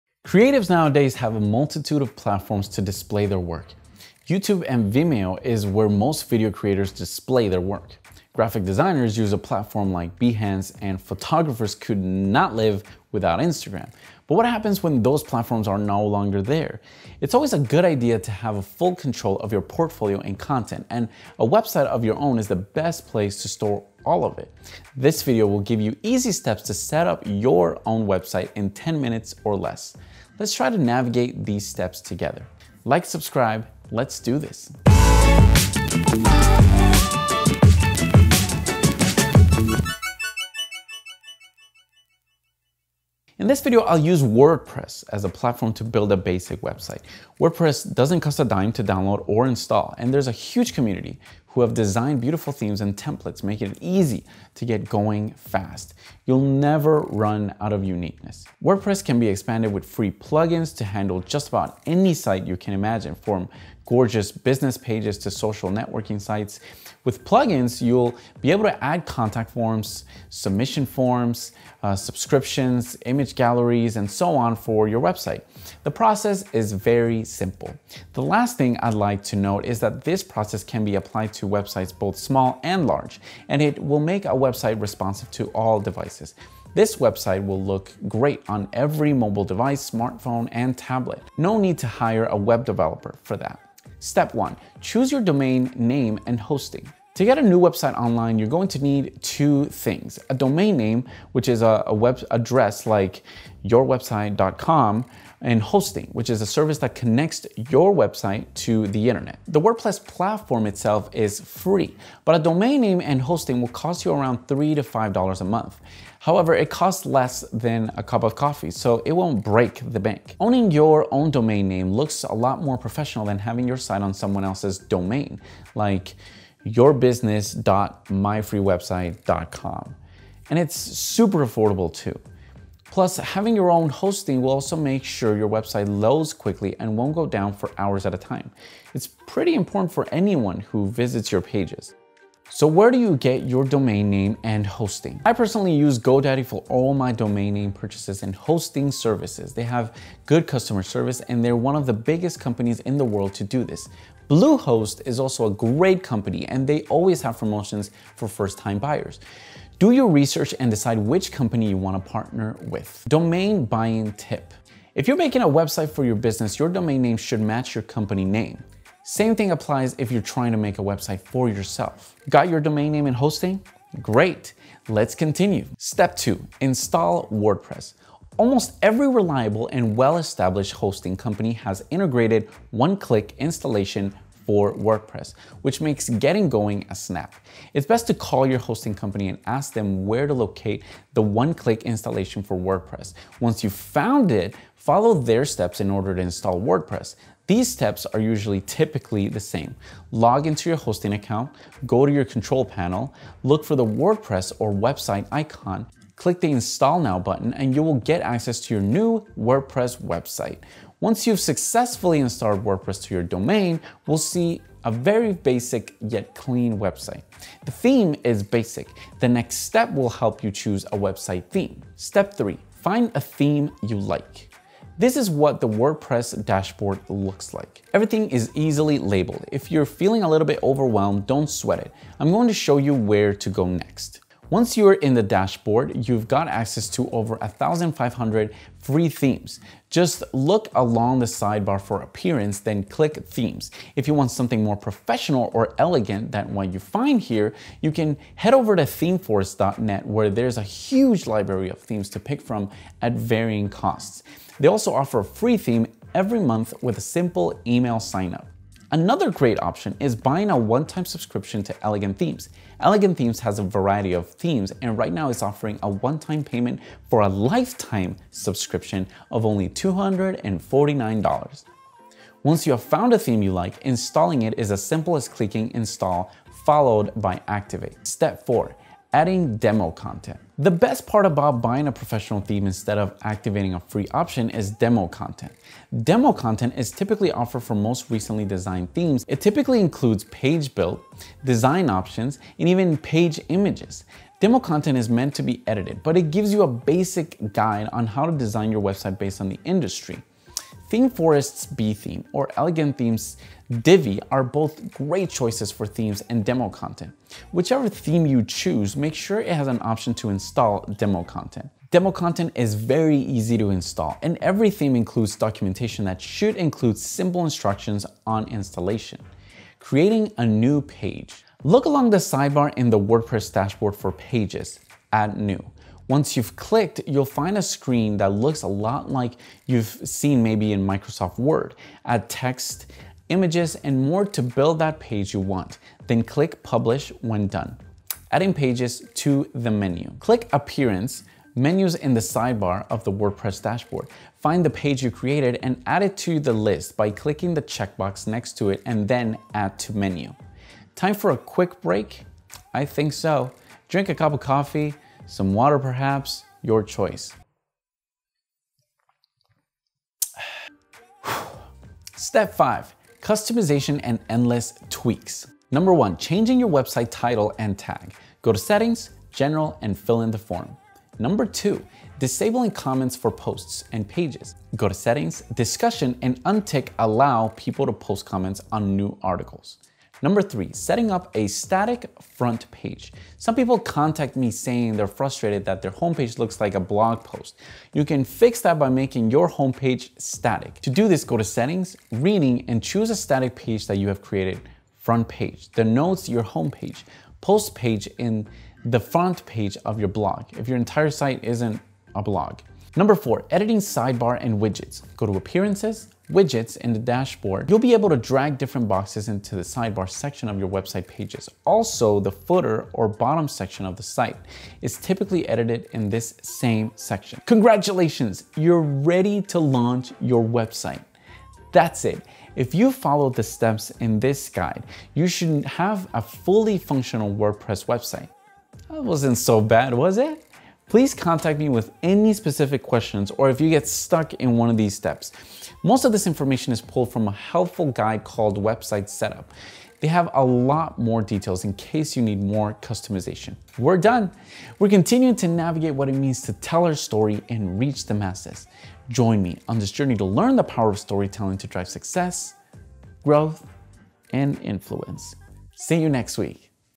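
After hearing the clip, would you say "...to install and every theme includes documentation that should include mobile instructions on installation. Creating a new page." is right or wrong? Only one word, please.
wrong.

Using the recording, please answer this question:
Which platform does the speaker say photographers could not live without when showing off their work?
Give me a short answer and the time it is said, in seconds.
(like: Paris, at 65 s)
Instagram, at 13 s.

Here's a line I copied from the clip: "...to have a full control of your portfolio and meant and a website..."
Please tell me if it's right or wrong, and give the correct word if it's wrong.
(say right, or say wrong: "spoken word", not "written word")
wrong: "content", not "meant".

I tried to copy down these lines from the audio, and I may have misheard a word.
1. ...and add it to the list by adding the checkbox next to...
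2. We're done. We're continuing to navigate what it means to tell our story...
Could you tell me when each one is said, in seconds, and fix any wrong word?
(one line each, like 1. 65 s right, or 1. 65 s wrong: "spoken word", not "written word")
1. 345 s wrong: "clicking", not "adding"
2. 443 s right.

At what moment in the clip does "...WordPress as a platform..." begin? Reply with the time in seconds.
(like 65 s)
44 s.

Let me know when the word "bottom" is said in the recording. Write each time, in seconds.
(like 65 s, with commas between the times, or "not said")
413 s.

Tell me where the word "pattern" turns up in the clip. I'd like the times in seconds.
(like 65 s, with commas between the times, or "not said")
not said.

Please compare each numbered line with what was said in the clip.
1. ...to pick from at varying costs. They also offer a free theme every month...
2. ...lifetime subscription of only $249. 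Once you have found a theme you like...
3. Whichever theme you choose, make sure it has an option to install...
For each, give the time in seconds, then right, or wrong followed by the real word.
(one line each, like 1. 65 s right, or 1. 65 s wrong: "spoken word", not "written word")
1. 252 s right
2. 267 s right
3. 307 s right.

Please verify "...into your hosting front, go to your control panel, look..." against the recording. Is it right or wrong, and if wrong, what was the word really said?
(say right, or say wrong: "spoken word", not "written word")
wrong: "account", not "front".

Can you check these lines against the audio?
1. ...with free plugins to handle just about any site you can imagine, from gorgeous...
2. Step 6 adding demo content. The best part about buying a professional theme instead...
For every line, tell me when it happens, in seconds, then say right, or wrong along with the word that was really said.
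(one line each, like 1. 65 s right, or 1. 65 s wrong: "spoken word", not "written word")
1. 59 s right
2. 278 s wrong: "4", not "6".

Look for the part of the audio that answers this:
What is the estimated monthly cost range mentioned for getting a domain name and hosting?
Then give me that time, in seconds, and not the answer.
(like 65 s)
114 s.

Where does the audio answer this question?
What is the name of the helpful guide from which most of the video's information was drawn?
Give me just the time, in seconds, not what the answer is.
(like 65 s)
438 s.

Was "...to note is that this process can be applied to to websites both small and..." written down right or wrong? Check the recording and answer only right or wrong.
right.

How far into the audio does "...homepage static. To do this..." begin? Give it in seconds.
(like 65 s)
389 s.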